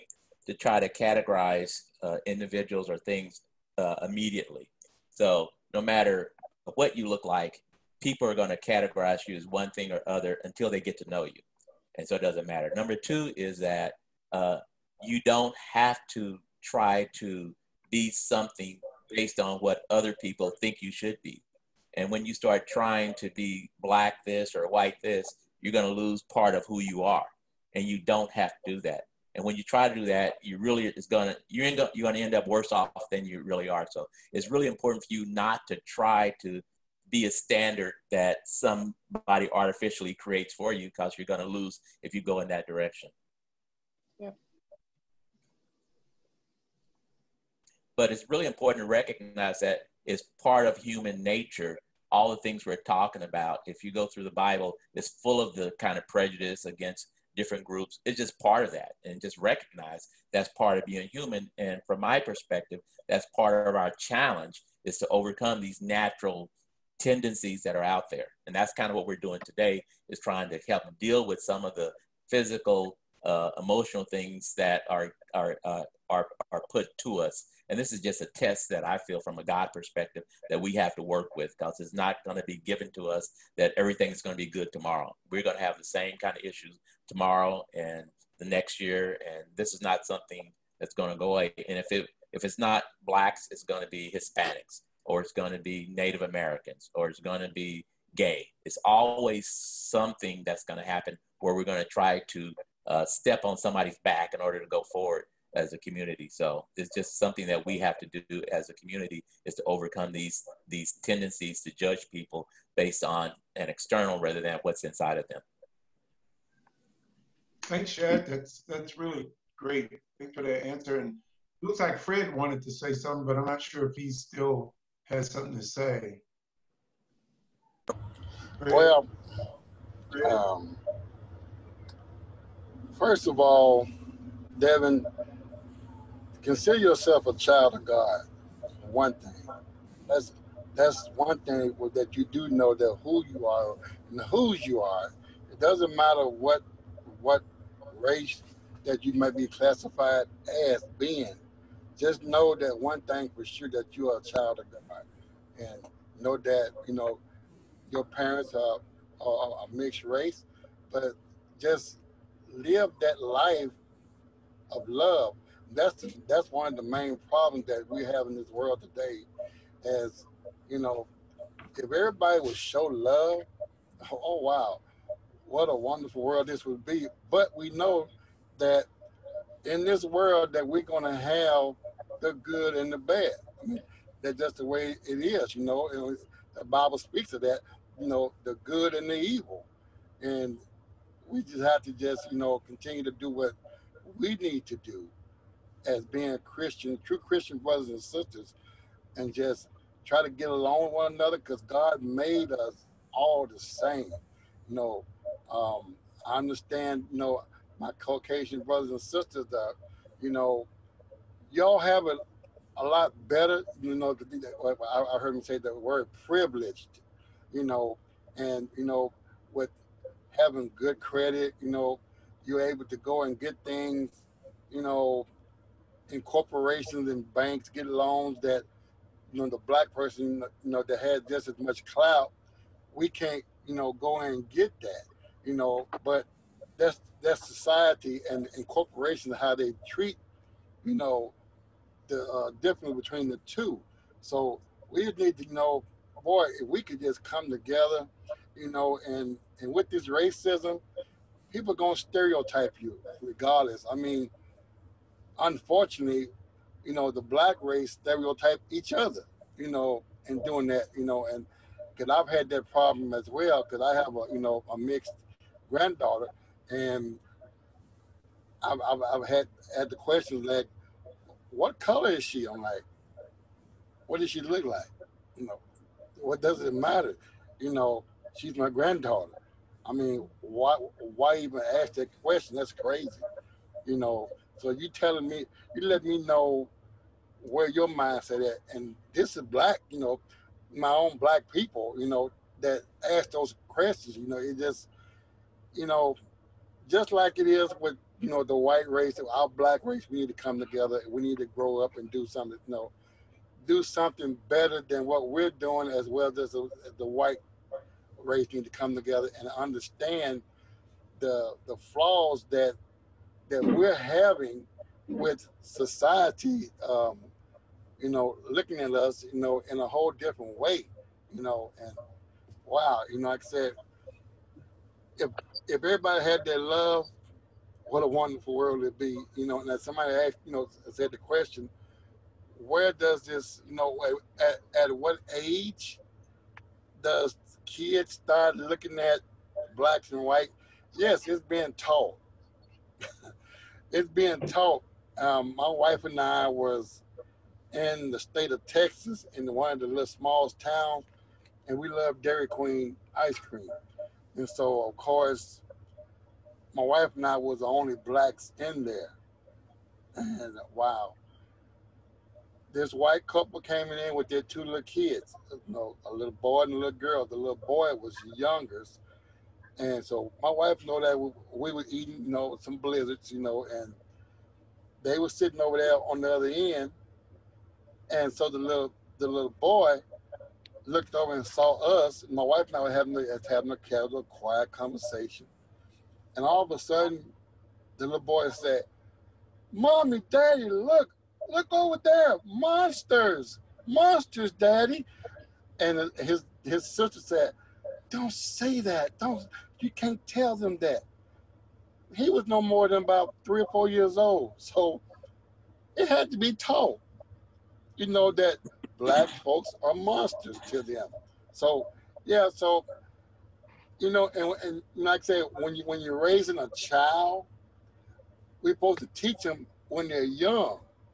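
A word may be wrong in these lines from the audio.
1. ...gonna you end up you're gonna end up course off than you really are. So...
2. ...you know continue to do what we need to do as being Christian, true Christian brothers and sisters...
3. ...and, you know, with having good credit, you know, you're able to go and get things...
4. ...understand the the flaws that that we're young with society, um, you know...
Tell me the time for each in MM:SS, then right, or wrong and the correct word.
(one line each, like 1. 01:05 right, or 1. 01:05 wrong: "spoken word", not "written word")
1. 00:31 wrong: "worse", not "course"
2. 03:12 right
3. 03:38 right
4. 05:09 wrong: "having", not "young".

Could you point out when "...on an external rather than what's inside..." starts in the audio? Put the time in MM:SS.
01:53.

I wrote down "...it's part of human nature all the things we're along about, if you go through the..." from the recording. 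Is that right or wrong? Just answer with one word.
wrong.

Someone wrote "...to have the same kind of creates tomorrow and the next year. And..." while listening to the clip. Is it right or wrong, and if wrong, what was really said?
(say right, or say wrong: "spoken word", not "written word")
wrong: "issues", not "creates".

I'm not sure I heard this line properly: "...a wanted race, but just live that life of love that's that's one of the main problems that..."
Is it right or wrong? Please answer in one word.
wrong.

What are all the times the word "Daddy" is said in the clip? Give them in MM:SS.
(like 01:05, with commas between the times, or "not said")
06:30, 06:34.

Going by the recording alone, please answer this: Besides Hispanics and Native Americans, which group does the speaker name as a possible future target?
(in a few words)
gay.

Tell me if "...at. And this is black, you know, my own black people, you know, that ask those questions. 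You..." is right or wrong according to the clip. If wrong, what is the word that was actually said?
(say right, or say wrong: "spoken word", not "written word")
right.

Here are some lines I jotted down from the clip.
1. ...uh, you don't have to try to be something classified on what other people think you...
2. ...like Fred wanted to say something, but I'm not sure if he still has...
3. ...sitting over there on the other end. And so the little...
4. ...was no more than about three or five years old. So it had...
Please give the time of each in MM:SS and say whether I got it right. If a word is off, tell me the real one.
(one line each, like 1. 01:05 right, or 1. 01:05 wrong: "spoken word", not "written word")
1. 00:14 wrong: "based", not "classified"
2. 02:01 right
3. 06:15 right
4. 06:42 wrong: "four", not "five".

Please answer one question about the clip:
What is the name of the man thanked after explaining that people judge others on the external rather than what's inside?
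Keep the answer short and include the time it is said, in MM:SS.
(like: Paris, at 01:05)
Chad, at 01:57.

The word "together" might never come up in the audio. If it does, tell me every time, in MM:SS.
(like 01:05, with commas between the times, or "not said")
04:07, 05:00, 05:08.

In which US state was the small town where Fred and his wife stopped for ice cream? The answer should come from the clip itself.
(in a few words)
Texas.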